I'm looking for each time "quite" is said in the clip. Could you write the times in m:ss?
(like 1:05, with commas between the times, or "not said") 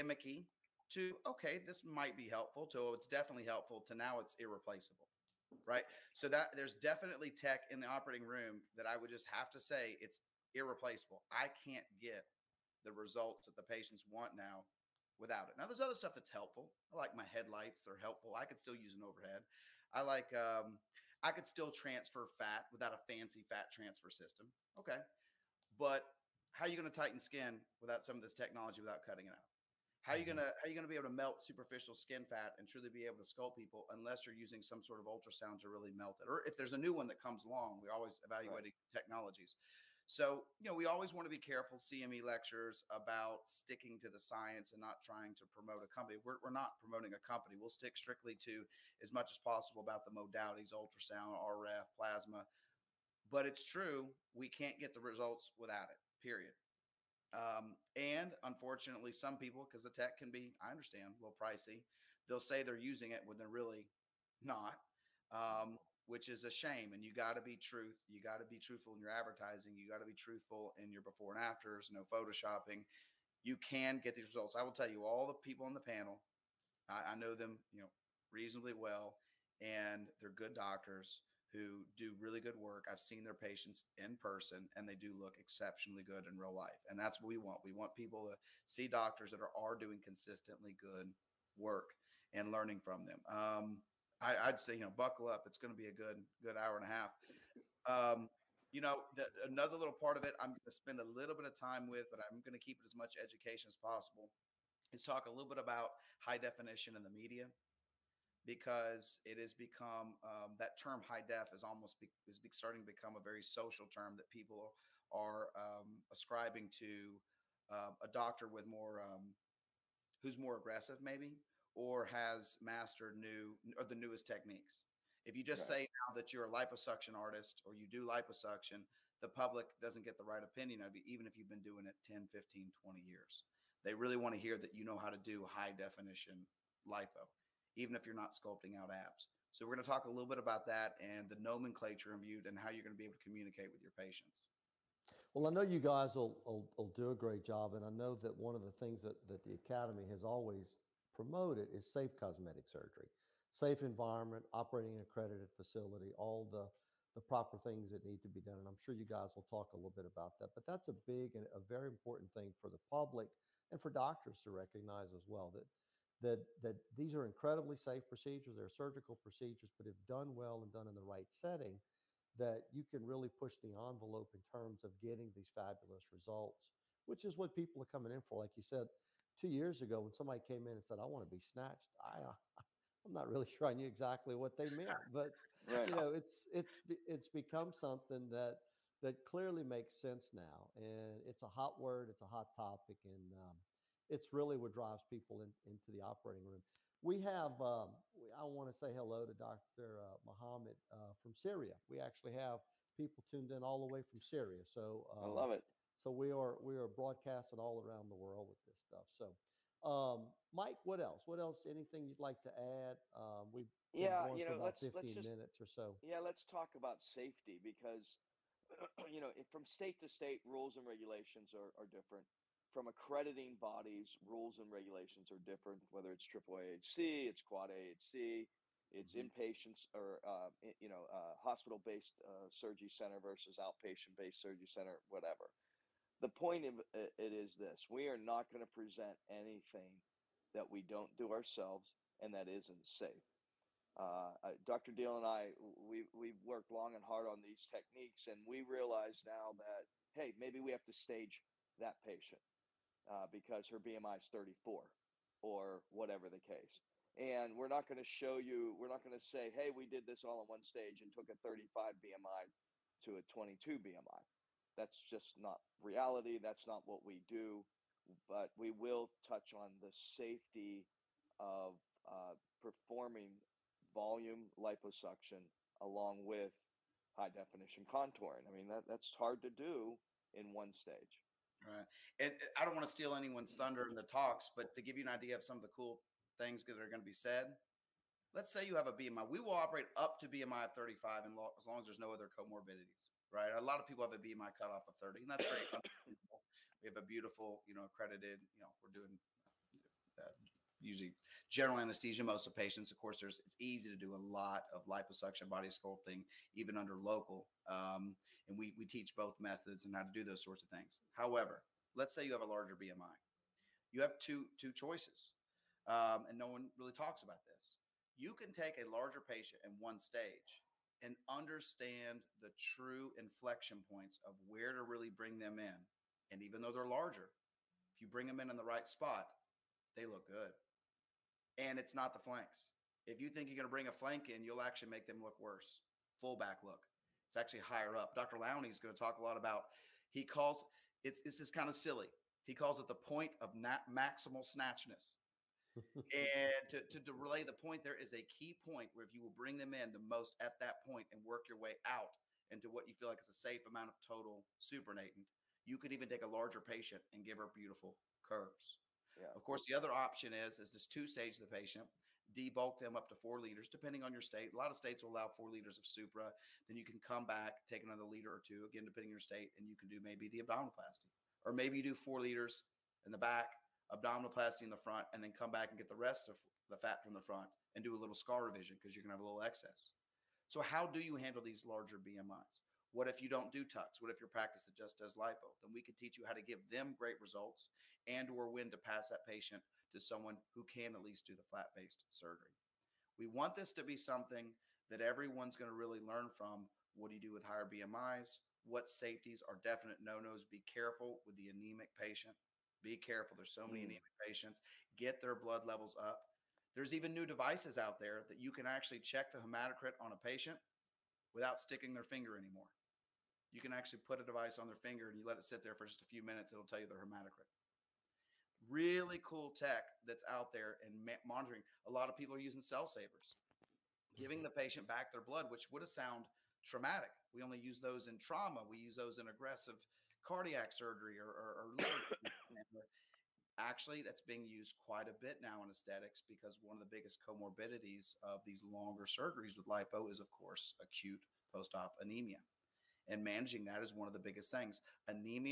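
7:14.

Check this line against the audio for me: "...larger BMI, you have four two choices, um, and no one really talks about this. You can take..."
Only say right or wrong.
wrong.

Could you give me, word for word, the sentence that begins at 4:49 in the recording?
We will operate up to BMI of 35 and as long as there's no other comorbidities right?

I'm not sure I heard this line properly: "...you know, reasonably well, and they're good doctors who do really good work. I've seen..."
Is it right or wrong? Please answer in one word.
right.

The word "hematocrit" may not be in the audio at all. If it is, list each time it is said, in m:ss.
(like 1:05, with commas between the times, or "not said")
6:49, 6:57.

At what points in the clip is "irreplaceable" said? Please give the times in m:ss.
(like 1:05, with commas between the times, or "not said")
0:04, 0:10.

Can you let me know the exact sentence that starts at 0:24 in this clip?
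Okay, but how are you going to tighten skin without some of this technology without cutting it out?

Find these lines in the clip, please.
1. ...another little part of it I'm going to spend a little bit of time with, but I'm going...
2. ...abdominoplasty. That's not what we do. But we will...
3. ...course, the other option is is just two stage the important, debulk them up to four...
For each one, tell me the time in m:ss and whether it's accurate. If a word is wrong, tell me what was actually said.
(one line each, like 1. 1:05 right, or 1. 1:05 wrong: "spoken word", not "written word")
1. 1:39 right
2. 4:25 wrong: "reality", not "abdominoplasty"
3. 5:59 wrong: "patient", not "important".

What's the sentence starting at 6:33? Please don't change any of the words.
We want this to be something that everyone's going to really learn from.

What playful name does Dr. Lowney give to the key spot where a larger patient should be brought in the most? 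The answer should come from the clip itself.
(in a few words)
Point of maximal snatchness.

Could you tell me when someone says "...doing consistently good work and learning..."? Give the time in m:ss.
1:29.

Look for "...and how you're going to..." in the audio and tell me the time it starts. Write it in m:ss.
2:22.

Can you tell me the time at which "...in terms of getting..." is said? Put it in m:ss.
2:54.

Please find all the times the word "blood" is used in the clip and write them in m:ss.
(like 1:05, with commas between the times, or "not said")
6:45, 7:05.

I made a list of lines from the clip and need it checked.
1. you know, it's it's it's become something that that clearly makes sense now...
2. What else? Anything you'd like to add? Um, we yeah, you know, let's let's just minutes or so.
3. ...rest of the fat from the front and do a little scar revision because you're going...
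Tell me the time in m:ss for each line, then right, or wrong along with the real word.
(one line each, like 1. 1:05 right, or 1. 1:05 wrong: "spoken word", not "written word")
1. 3:05 right
2. 3:31 right
3. 6:15 right.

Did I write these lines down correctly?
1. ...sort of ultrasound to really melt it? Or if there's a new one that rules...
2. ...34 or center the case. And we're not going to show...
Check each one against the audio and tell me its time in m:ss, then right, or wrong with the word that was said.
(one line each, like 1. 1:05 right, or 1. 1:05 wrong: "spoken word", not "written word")
1. 0:34 wrong: "comes", not "rules"
2. 4:14 wrong: "whatever", not "center".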